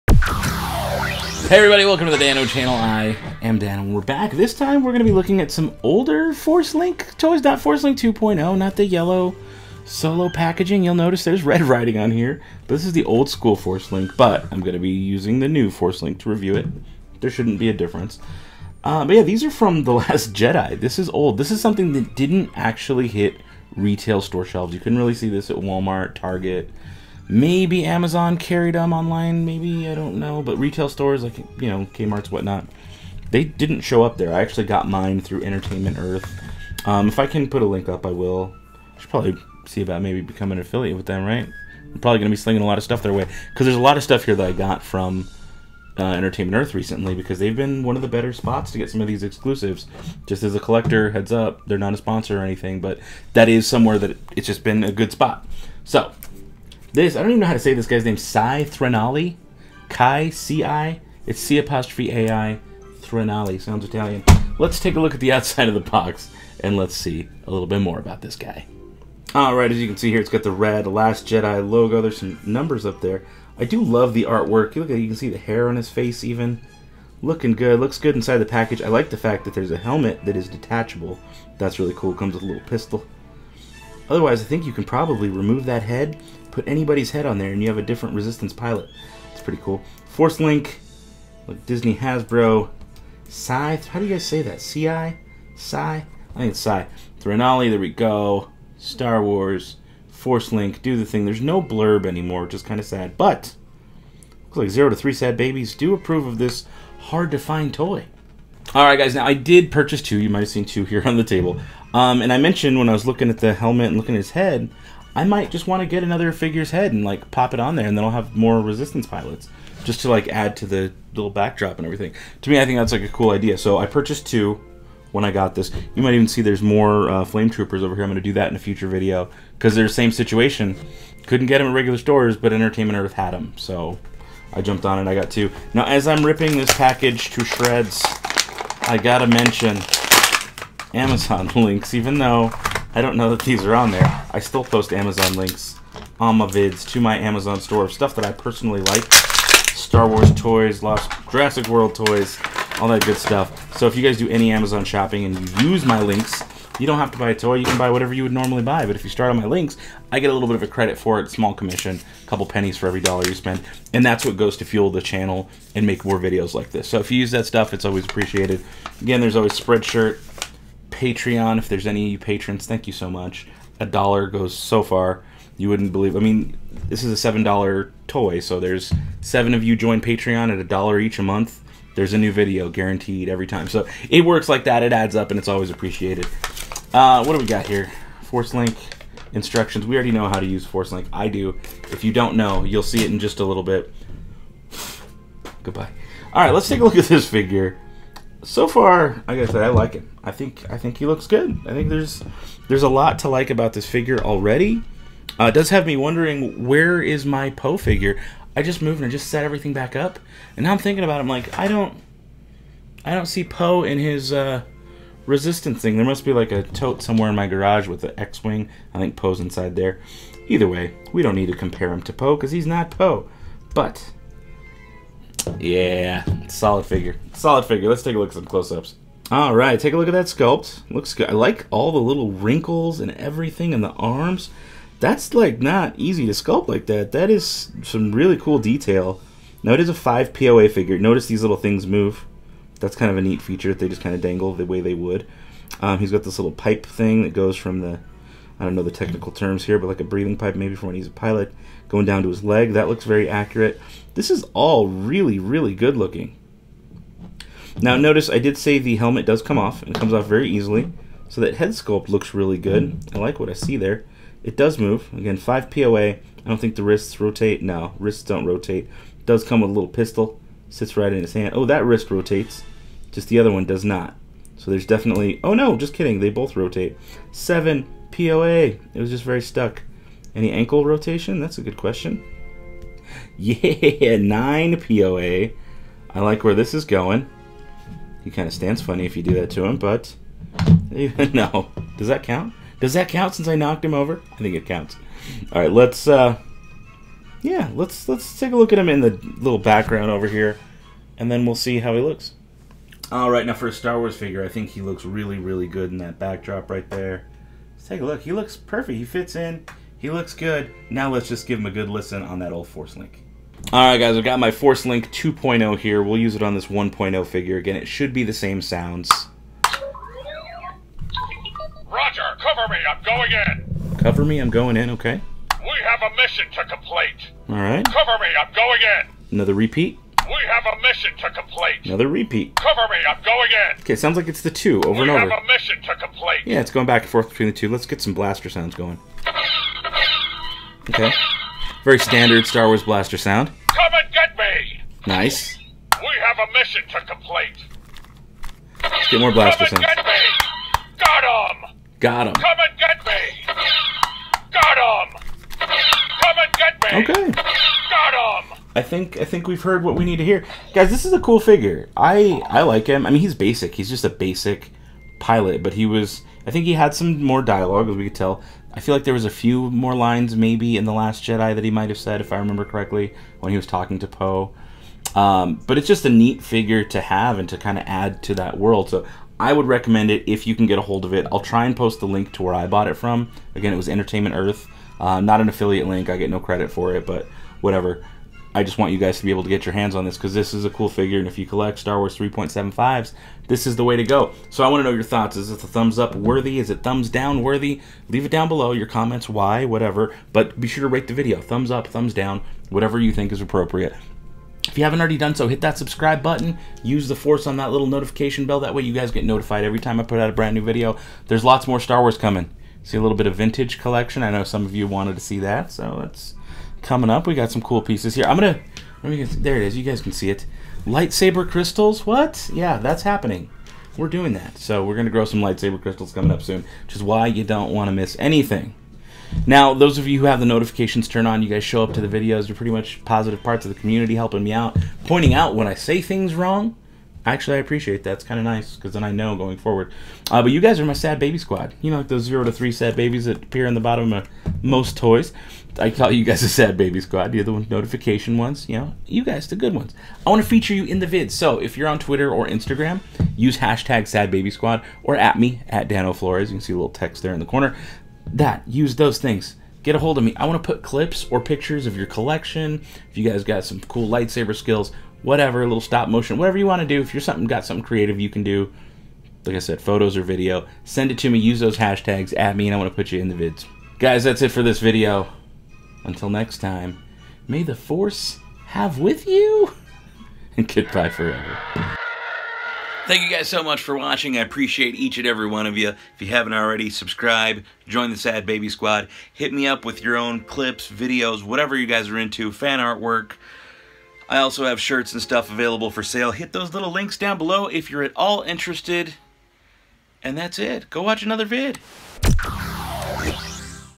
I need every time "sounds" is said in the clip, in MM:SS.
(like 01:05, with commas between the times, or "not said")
01:03, 05:18, 05:33, 05:38, 05:43, 05:49.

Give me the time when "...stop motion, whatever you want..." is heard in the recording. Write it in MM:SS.
07:45.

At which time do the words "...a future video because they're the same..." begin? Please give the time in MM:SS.
02:08.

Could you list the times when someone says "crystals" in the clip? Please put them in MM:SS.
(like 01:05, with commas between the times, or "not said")
07:01, 07:05.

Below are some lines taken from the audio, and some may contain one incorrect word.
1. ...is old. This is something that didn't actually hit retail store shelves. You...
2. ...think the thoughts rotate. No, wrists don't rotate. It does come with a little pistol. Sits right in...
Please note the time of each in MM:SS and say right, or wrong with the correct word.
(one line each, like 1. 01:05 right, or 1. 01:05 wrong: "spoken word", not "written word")
1. 00:20 right
2. 04:26 wrong: "wrists", not "thoughts".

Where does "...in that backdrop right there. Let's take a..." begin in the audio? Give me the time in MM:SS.
05:05.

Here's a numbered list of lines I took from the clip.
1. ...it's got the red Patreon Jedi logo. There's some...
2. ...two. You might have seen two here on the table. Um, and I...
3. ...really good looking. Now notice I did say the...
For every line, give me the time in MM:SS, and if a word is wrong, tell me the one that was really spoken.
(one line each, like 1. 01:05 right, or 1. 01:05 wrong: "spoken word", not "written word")
1. 01:10 wrong: "Last", not "Patreon"
2. 01:50 right
3. 04:15 right.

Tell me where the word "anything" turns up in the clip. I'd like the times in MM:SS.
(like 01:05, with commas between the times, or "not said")
00:52, 07:08.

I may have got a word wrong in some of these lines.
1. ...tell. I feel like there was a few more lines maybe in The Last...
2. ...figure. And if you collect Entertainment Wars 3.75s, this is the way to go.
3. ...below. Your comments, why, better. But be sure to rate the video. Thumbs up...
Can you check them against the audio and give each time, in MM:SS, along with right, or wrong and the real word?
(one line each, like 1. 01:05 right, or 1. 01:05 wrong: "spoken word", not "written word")
1. 06:08 right
2. 06:30 wrong: "Star", not "Entertainment"
3. 06:38 wrong: "whatever", not "better".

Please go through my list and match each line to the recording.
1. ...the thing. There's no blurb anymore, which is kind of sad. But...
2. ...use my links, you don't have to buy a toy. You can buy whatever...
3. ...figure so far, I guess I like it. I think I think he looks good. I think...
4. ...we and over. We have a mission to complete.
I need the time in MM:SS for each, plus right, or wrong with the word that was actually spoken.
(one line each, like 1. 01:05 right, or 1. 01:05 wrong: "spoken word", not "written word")
1. 01:40 right
2. 02:35 right
3. 03:17 right
4. 05:35 right.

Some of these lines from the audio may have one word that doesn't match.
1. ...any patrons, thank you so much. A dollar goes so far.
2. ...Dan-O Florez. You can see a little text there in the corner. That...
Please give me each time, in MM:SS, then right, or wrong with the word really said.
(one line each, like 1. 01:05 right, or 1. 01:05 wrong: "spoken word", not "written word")
1. 02:51 right
2. 07:35 right.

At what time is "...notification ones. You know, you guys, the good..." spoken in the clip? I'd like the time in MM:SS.
07:27.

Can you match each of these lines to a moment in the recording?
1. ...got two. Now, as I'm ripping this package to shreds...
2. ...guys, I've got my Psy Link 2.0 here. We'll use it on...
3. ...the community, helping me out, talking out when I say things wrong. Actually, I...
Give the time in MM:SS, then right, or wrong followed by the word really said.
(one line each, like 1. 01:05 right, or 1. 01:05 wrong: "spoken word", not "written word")
1. 02:15 right
2. 05:13 wrong: "Force", not "Psy"
3. 07:13 wrong: "pointing", not "talking".